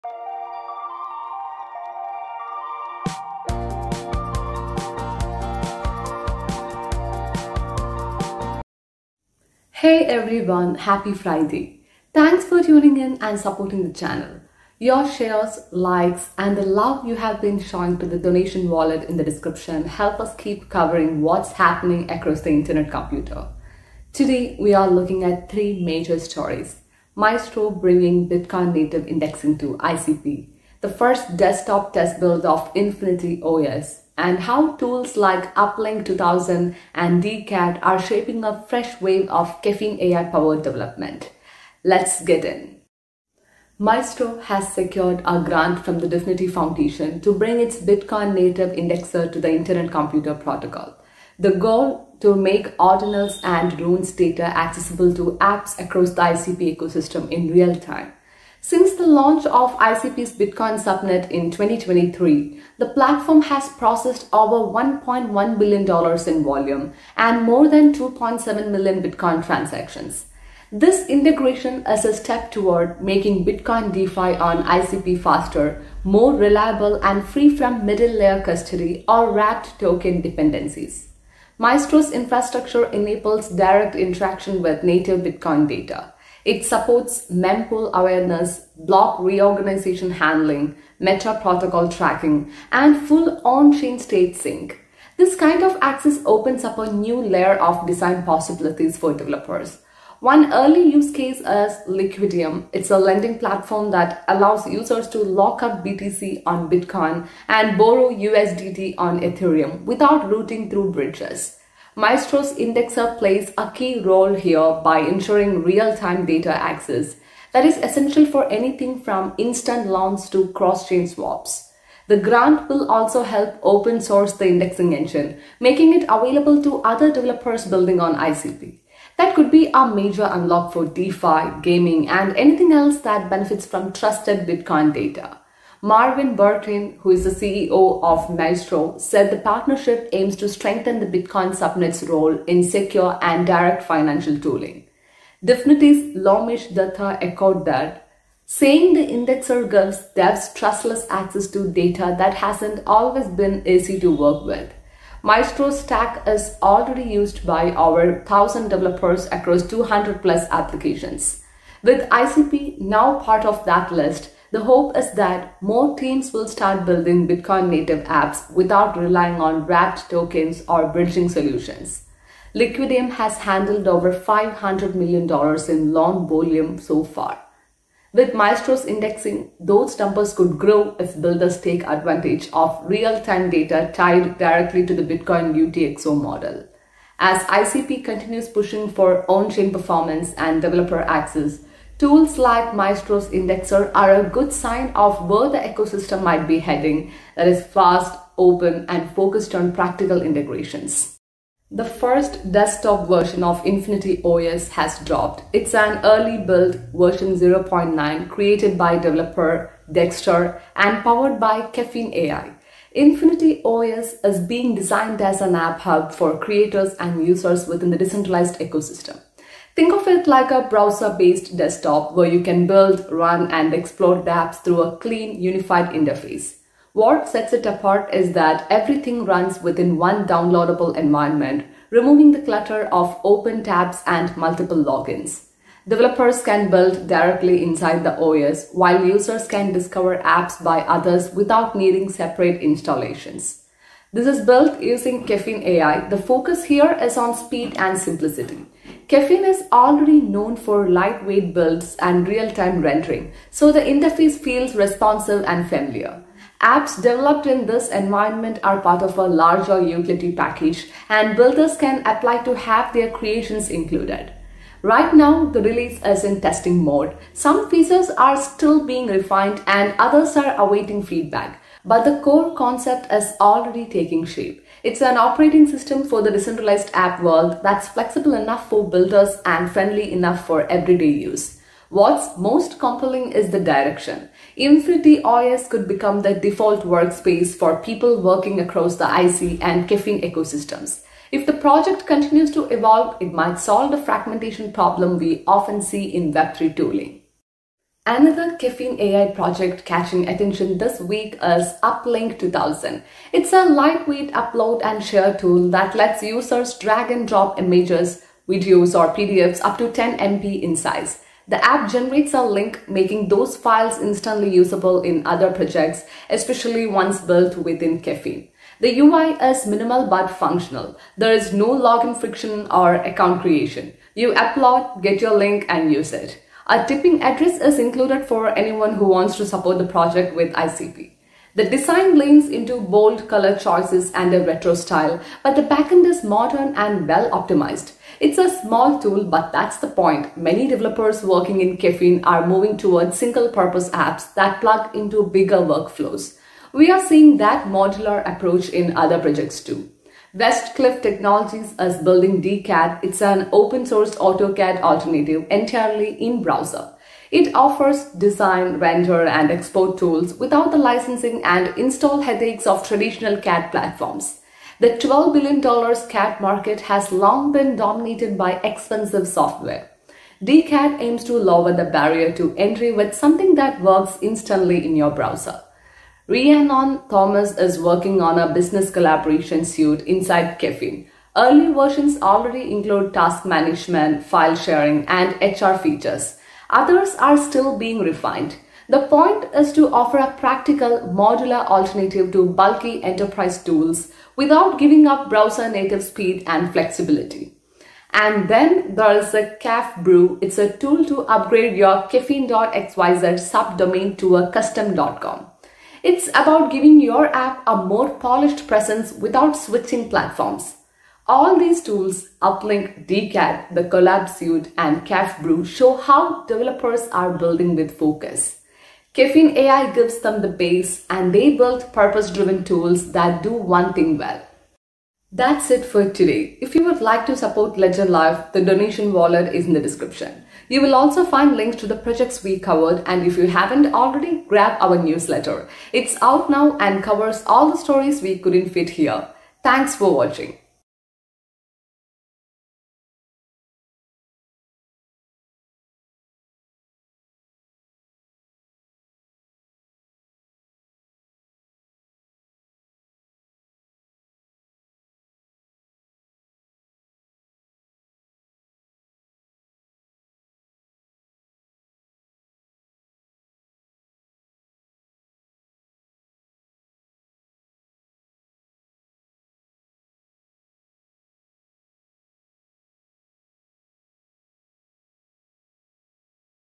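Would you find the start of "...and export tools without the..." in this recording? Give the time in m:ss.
5:59.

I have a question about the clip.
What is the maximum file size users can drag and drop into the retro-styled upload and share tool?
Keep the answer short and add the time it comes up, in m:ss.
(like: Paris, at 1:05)
10 MB, at 5:09.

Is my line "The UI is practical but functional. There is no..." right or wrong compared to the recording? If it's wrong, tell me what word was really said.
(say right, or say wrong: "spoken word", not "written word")
wrong: "minimal", not "practical".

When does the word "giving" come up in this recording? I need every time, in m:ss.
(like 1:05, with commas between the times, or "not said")
6:34, 6:46.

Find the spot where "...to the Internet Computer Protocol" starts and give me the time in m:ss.
0:49.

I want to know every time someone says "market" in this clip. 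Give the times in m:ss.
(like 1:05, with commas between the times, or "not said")
6:06.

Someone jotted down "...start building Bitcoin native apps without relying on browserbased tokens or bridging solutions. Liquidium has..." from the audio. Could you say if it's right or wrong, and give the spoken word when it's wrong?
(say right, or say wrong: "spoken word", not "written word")
wrong: "wrapped", not "browserbased".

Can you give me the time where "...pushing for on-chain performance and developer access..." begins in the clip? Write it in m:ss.
3:08.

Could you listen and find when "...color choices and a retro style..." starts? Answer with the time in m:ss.
5:33.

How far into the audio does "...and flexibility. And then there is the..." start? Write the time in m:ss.
6:36.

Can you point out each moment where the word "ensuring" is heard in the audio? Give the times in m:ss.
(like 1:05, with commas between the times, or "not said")
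1:54.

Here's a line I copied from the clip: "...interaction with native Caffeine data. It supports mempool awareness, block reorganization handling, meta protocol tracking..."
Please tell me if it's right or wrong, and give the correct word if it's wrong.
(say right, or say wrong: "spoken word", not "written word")
wrong: "Bitcoin", not "Caffeine".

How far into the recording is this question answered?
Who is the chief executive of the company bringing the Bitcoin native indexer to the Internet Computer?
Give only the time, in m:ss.
2:15.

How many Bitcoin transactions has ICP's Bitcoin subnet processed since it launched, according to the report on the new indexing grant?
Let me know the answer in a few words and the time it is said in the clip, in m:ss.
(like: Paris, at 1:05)
2.7 million, at 1:07.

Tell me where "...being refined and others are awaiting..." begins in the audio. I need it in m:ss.
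4:28.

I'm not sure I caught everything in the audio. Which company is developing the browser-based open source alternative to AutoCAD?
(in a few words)
Westcliff Technologies.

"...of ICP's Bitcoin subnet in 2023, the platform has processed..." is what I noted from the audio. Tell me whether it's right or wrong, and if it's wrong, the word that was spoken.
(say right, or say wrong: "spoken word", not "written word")
right.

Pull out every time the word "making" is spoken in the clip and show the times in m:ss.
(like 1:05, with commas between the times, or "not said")
1:13, 2:05, 5:12.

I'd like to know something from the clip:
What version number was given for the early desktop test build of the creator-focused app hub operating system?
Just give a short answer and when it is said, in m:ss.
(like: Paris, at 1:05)
0.9, at 3:27.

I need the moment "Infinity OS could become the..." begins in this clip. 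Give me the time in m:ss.
4:44.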